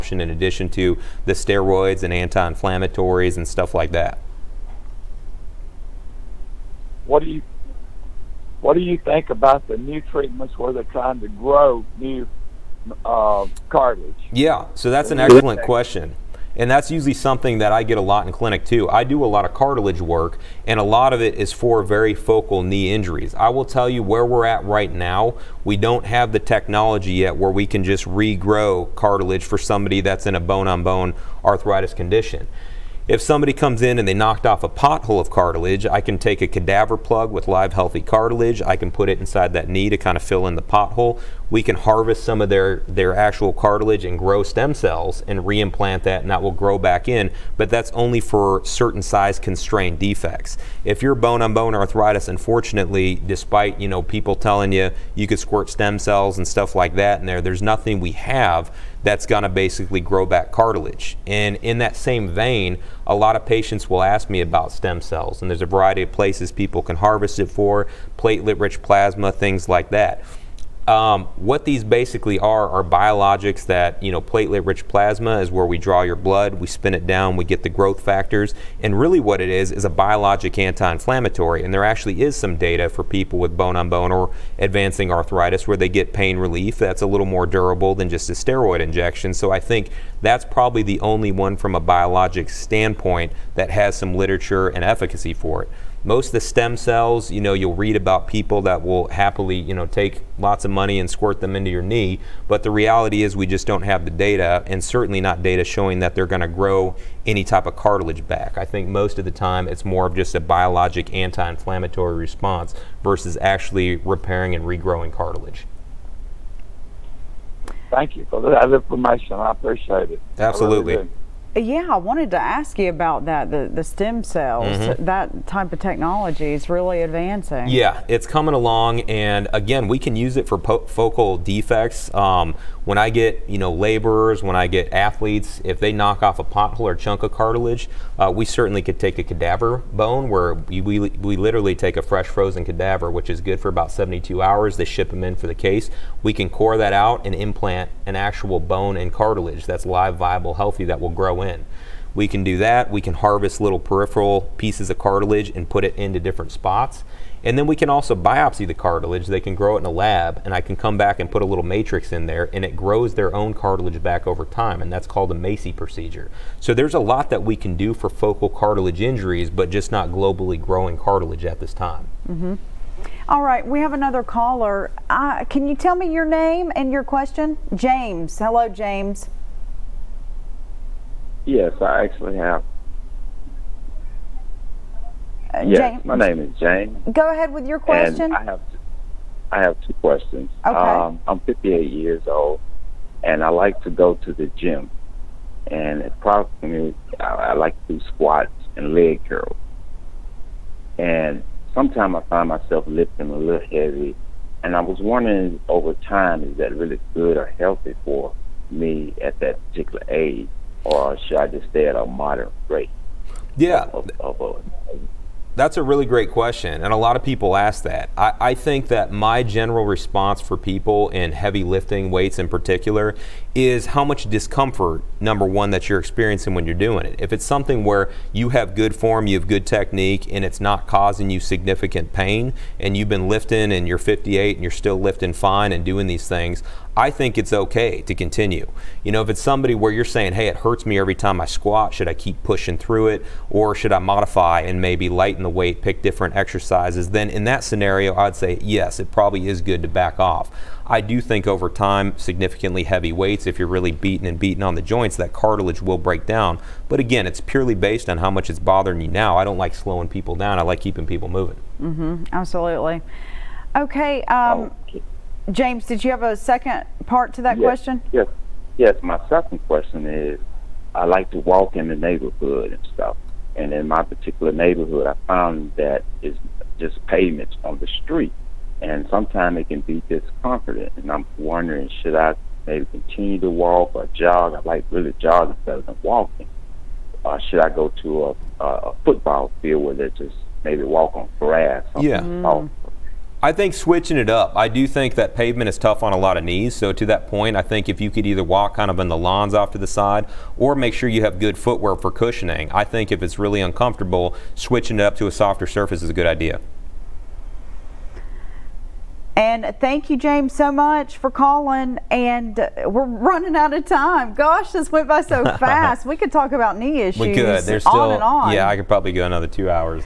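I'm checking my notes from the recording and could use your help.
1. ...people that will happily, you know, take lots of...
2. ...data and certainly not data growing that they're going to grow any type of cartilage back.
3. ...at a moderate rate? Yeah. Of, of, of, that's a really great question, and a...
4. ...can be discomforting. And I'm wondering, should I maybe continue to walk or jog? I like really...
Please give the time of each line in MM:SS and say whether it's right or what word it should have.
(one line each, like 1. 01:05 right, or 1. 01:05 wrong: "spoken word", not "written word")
1. 01:38 right
2. 01:44 wrong: "showing", not "growing"
3. 03:31 right
4. 04:39 right.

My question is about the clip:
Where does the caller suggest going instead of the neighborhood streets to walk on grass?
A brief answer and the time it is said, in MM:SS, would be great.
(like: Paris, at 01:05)
A football field, at 04:49.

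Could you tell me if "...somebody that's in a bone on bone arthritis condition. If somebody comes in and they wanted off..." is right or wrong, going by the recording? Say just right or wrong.
wrong.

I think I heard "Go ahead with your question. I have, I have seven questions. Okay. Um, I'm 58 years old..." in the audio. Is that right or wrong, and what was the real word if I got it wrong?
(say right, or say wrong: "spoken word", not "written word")
wrong: "two", not "seven".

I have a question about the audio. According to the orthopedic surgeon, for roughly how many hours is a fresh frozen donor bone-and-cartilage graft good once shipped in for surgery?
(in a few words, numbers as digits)
72 hours.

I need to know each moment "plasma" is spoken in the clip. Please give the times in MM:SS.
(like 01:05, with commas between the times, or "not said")
01:08, 01:14.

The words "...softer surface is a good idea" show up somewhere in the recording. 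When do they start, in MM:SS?
05:05.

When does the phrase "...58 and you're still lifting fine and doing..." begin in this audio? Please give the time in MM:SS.
03:53.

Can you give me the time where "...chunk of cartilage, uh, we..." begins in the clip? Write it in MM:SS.
02:16.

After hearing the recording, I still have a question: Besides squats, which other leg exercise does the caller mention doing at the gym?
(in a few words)
Leg curls.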